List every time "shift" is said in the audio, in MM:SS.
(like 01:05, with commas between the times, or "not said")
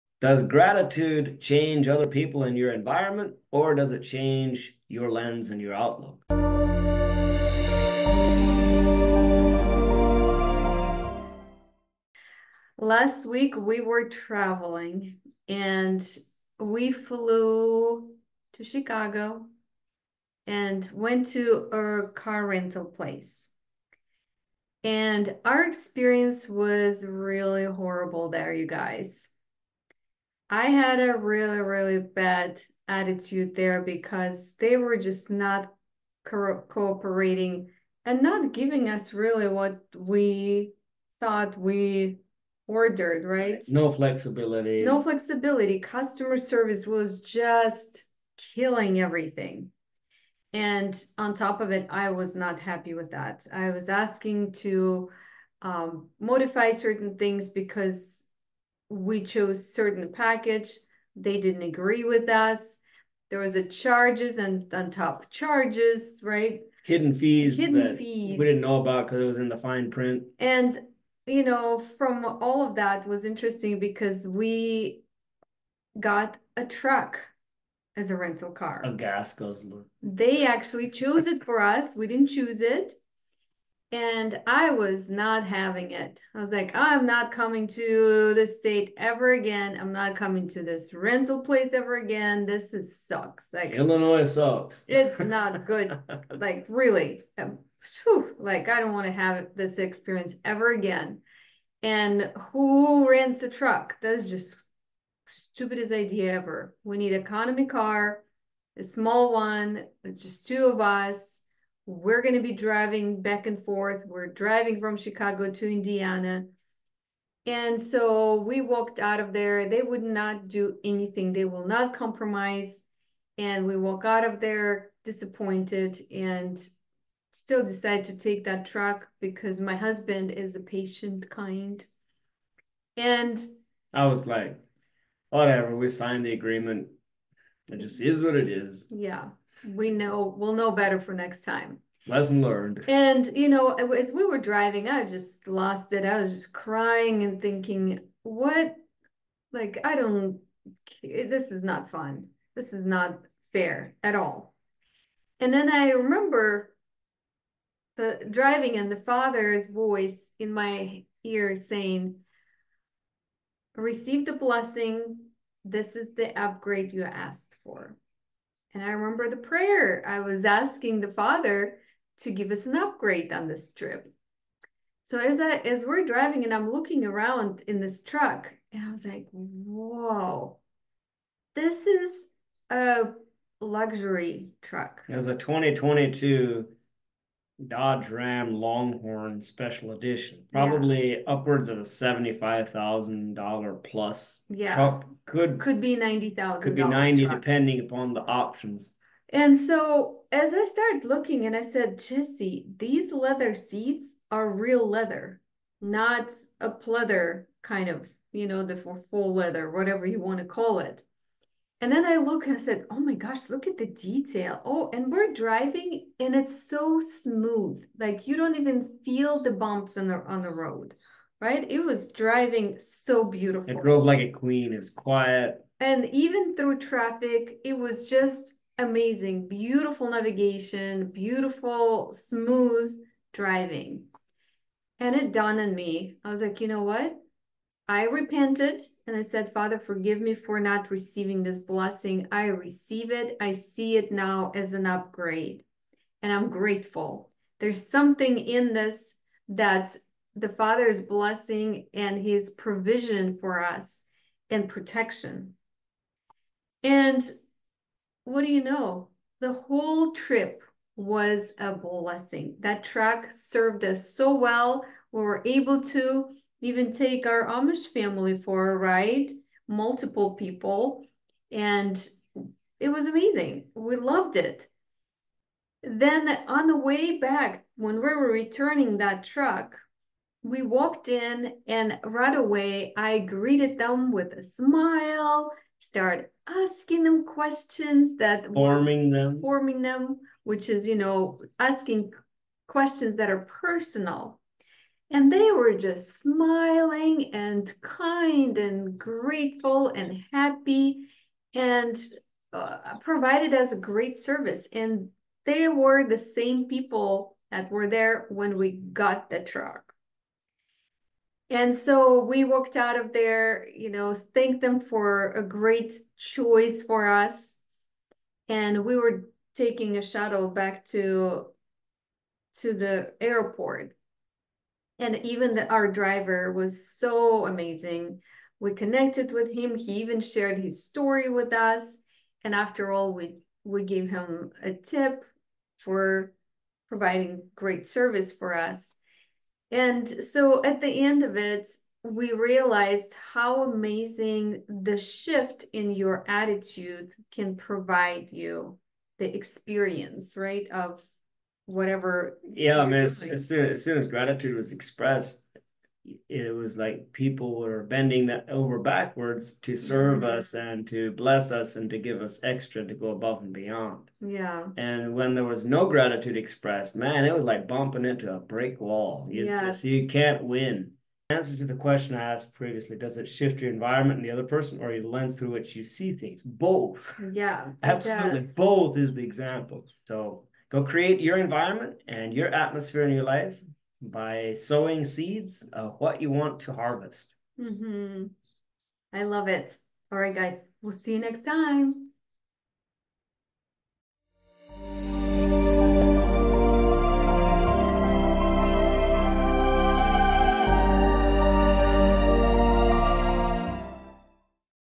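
05:44, 06:13.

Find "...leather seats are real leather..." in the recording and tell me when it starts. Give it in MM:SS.
03:23.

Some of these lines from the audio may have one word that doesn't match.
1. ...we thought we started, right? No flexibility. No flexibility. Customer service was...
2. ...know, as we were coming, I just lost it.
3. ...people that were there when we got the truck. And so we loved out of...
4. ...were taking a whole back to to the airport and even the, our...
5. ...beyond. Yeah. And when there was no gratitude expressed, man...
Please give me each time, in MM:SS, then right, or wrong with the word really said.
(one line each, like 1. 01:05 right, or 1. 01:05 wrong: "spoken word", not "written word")
1. 00:39 wrong: "ordered", not "started"
2. 02:23 wrong: "driving", not "coming"
3. 05:06 wrong: "walked", not "loved"
4. 05:18 wrong: "shuttle", not "whole"
5. 06:03 right.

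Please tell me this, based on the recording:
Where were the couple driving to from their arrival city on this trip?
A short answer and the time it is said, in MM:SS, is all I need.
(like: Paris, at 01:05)
Indiana, at 01:55.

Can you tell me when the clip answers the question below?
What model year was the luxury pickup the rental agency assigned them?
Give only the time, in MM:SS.
03:05.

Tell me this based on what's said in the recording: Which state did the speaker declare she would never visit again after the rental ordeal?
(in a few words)
Illinois.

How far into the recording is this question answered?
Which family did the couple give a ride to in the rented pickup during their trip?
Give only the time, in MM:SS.
04:27.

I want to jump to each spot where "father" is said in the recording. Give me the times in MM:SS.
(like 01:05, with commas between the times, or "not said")
02:38, 02:51, 03:59, 04:10.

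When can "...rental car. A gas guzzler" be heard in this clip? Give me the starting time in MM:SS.
01:18.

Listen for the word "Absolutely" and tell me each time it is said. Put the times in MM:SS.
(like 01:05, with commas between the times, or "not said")
06:17.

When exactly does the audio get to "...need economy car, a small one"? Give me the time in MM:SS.
01:46.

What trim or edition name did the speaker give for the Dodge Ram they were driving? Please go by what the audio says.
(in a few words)
Longhorn Special Edition.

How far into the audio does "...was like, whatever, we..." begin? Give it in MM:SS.
02:14.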